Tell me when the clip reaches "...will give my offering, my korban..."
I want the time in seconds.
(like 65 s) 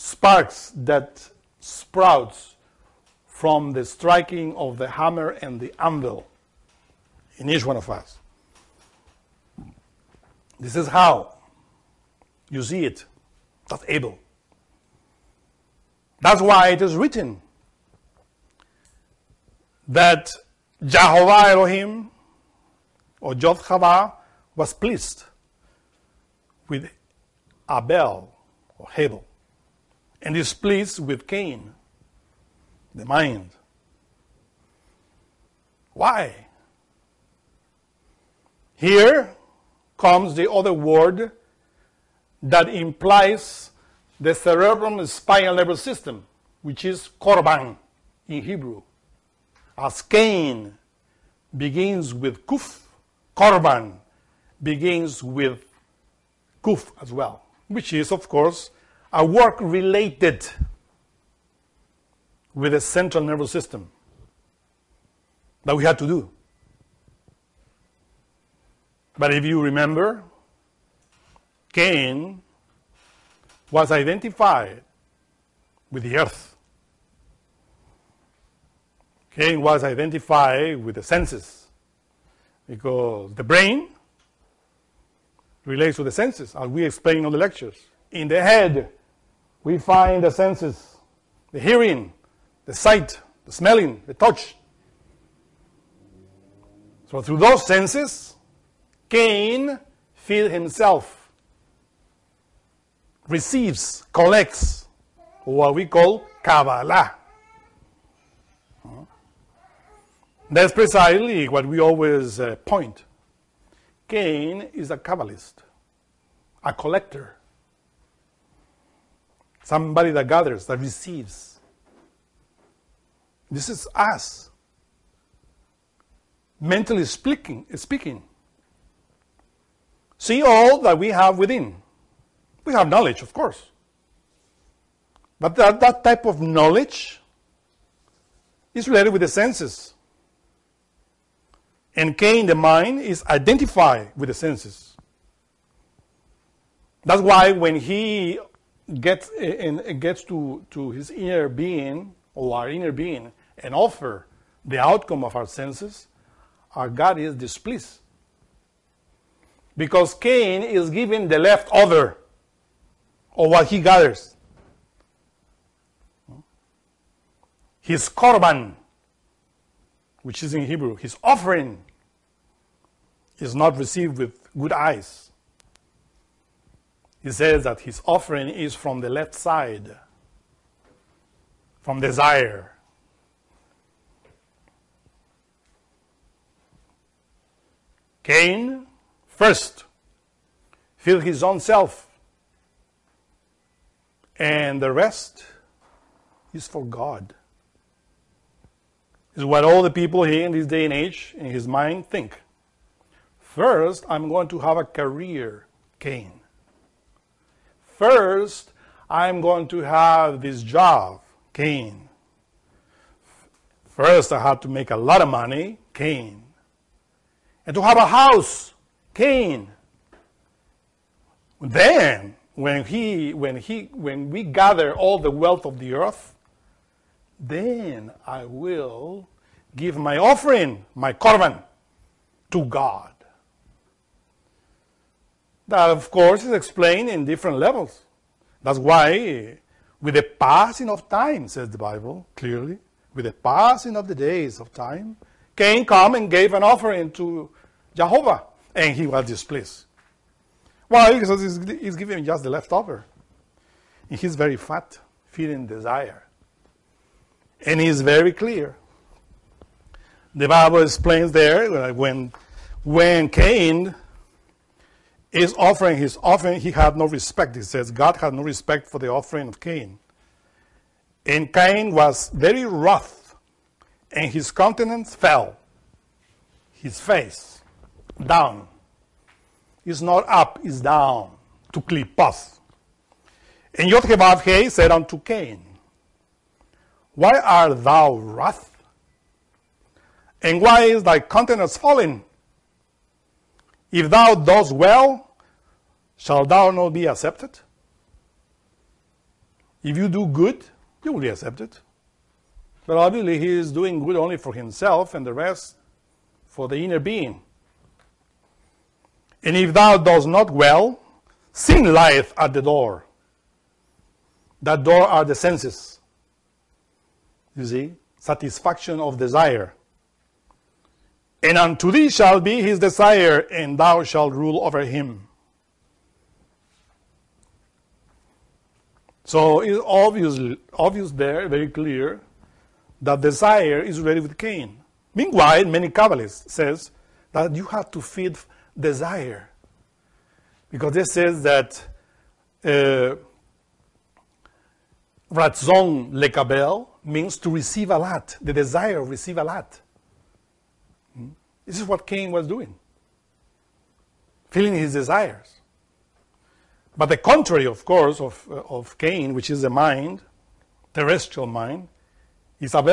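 228 s.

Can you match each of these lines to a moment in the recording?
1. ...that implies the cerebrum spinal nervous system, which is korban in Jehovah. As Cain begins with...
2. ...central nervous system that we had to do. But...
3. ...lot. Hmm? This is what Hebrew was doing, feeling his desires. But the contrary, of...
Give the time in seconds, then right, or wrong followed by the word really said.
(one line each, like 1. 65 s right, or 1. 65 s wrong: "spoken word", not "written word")
1. 42 s wrong: "Hebrew", not "Jehovah"
2. 62 s right
3. 349 s wrong: "Cain", not "Hebrew".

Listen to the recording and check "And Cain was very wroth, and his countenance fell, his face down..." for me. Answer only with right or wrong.
right.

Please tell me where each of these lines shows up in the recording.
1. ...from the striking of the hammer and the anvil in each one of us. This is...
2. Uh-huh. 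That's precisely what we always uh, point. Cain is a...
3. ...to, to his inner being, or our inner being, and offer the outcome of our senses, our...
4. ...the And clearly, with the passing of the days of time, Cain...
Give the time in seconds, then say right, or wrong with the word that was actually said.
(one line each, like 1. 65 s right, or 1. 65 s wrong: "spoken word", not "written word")
1. 3 s right
2. 108 s right
3. 150 s right
4. 241 s wrong: "Bible", not "And".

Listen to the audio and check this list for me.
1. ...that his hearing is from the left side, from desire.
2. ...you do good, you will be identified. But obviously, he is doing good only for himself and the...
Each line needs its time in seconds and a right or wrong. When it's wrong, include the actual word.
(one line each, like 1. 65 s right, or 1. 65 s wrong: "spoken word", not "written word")
1. 177 s wrong: "offering", not "hearing"
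2. 299 s wrong: "accepted", not "identified".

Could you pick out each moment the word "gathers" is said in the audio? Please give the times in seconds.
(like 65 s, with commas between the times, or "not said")
120 s, 163 s, 224 s.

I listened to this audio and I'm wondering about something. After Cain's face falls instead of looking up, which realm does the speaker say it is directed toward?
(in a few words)
Klipoth.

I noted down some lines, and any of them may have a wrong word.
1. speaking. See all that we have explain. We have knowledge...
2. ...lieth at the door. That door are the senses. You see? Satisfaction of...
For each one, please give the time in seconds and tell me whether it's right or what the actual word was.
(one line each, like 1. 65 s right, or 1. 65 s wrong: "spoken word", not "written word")
1. 127 s wrong: "within", not "explain"
2. 311 s right.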